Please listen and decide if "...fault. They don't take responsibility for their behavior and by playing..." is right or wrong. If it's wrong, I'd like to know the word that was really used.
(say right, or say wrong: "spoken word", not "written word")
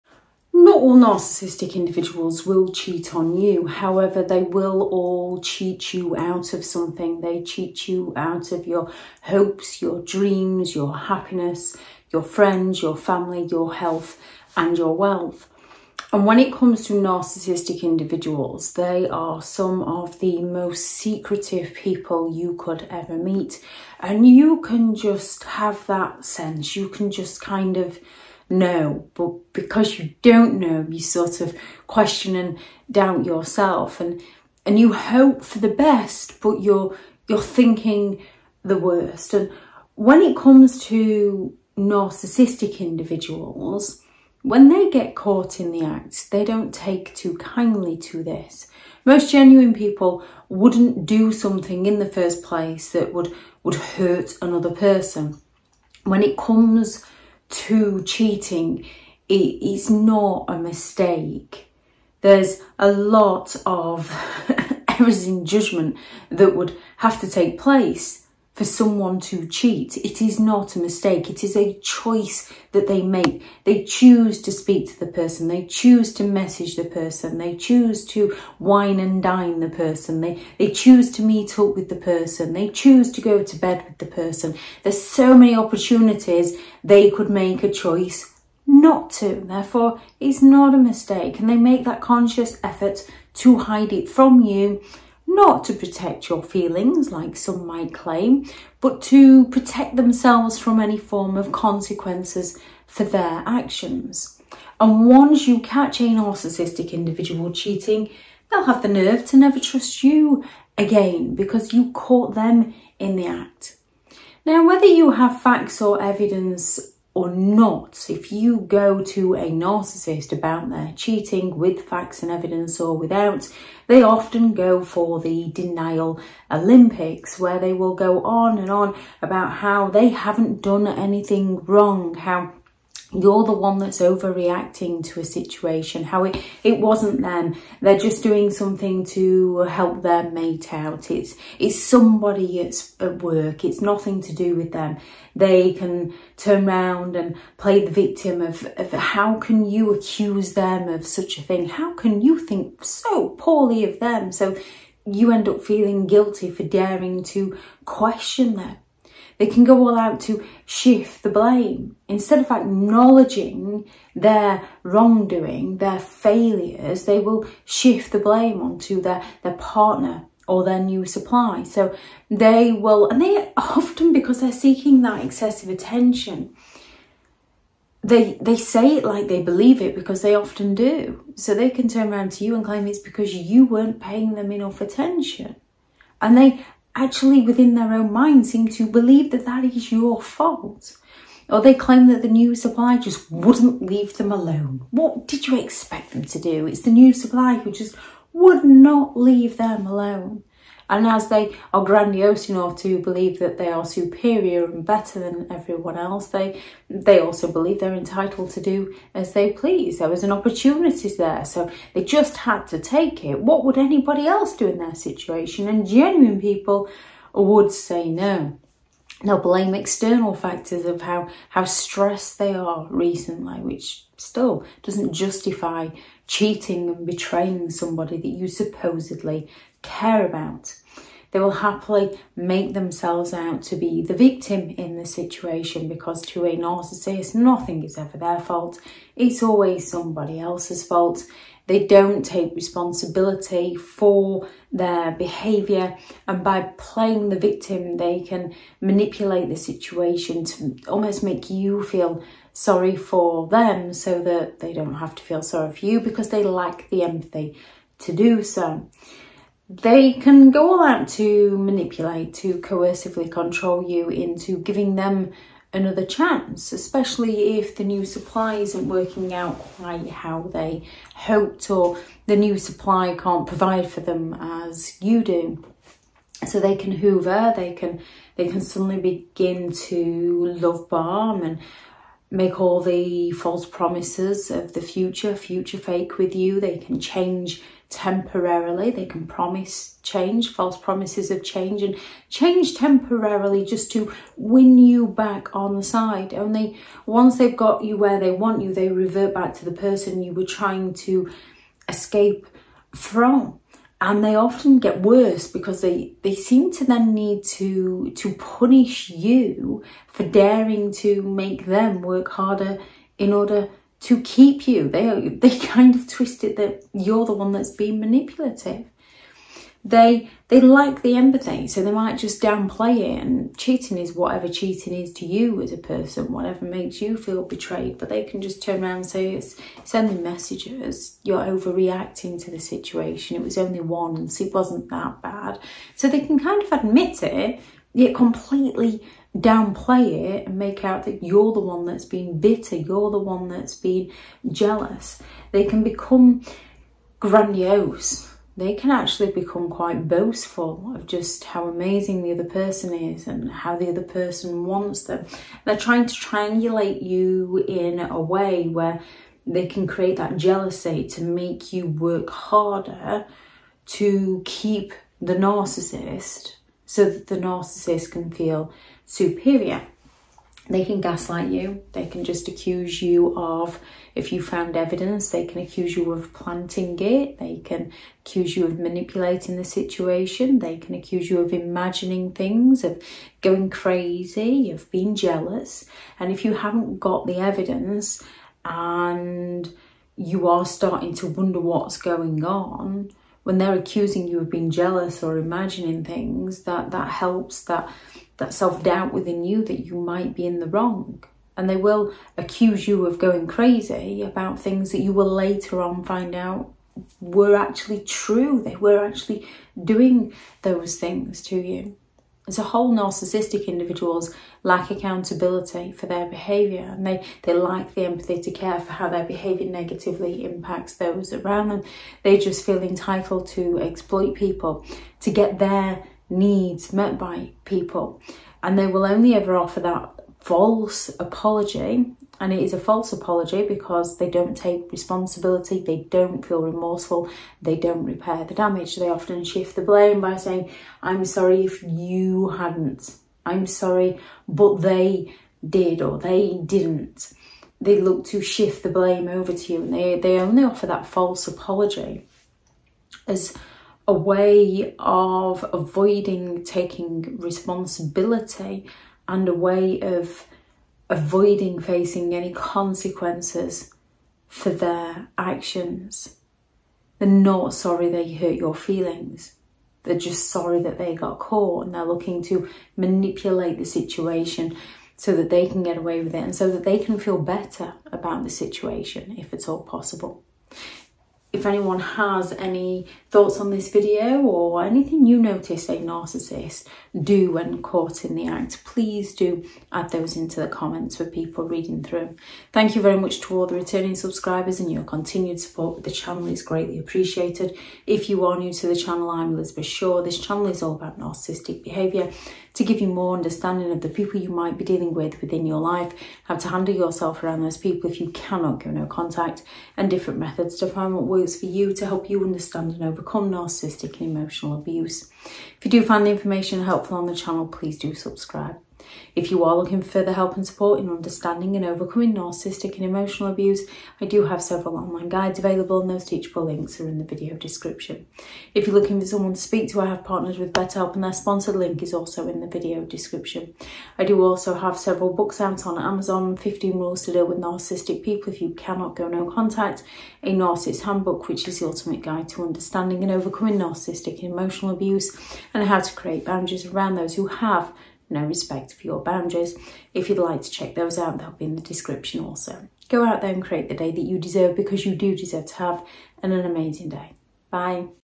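right.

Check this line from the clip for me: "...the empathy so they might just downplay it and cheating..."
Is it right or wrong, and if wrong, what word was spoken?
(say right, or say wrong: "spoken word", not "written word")
right.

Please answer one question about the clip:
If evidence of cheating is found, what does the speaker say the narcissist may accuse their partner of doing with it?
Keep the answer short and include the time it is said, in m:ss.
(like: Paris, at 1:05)
Planting it, at 6:16.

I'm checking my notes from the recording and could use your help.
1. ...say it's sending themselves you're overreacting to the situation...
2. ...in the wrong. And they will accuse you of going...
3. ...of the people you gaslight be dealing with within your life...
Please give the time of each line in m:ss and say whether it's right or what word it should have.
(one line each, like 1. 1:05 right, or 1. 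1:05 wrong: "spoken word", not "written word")
1. 5:29 wrong: "messages", not "themselves"
2. 6:40 right
3. 8:23 wrong: "might", not "gaslight".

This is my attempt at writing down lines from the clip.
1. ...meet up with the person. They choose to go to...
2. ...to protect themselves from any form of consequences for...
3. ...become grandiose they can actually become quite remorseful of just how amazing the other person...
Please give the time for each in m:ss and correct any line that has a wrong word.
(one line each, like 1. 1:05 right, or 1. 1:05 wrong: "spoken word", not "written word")
1. 1:21 right
2. 1:39 right
3. 5:45 wrong: "boastful", not "remorseful".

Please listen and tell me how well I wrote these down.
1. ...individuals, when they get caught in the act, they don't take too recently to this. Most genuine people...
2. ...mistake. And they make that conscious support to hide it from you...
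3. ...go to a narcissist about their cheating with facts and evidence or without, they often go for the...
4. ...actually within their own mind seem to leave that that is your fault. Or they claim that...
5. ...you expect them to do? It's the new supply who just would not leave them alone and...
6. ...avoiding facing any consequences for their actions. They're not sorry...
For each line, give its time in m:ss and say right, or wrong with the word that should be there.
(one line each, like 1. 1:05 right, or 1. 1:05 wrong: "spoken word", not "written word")
1. 0:42 wrong: "kindly", not "recently"
2. 1:30 wrong: "effort", not "support"
3. 1:58 right
4. 3:06 wrong: "believe", not "leave"
5. 3:15 right
6. 7:41 right.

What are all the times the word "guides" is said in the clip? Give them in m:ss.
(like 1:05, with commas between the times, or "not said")
8:45, 9:02.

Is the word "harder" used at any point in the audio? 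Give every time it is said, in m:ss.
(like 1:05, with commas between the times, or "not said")
5:12, 6:02.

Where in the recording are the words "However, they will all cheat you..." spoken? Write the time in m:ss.
0:03.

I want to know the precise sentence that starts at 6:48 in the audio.
They were actually doing those things to you.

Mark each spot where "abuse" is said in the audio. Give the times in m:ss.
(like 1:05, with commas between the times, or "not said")
8:34, 8:43, 9:04.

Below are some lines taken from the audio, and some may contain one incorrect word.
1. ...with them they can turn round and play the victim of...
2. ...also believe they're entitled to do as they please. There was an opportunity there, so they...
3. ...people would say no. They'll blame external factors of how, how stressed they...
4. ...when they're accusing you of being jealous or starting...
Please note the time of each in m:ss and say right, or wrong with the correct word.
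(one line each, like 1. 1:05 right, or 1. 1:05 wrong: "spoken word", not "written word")
1. 2:24 right
2. 3:27 right
3. 3:36 right
4. 6:33 wrong: "imagining", not "starting".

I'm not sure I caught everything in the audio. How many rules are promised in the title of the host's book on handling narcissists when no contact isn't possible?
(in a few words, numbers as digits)
15.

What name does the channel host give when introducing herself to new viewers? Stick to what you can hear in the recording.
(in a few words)
Elizabeth Shaw.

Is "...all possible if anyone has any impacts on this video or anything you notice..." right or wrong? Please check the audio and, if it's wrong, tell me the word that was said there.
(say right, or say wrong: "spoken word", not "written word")
wrong: "thoughts", not "impacts".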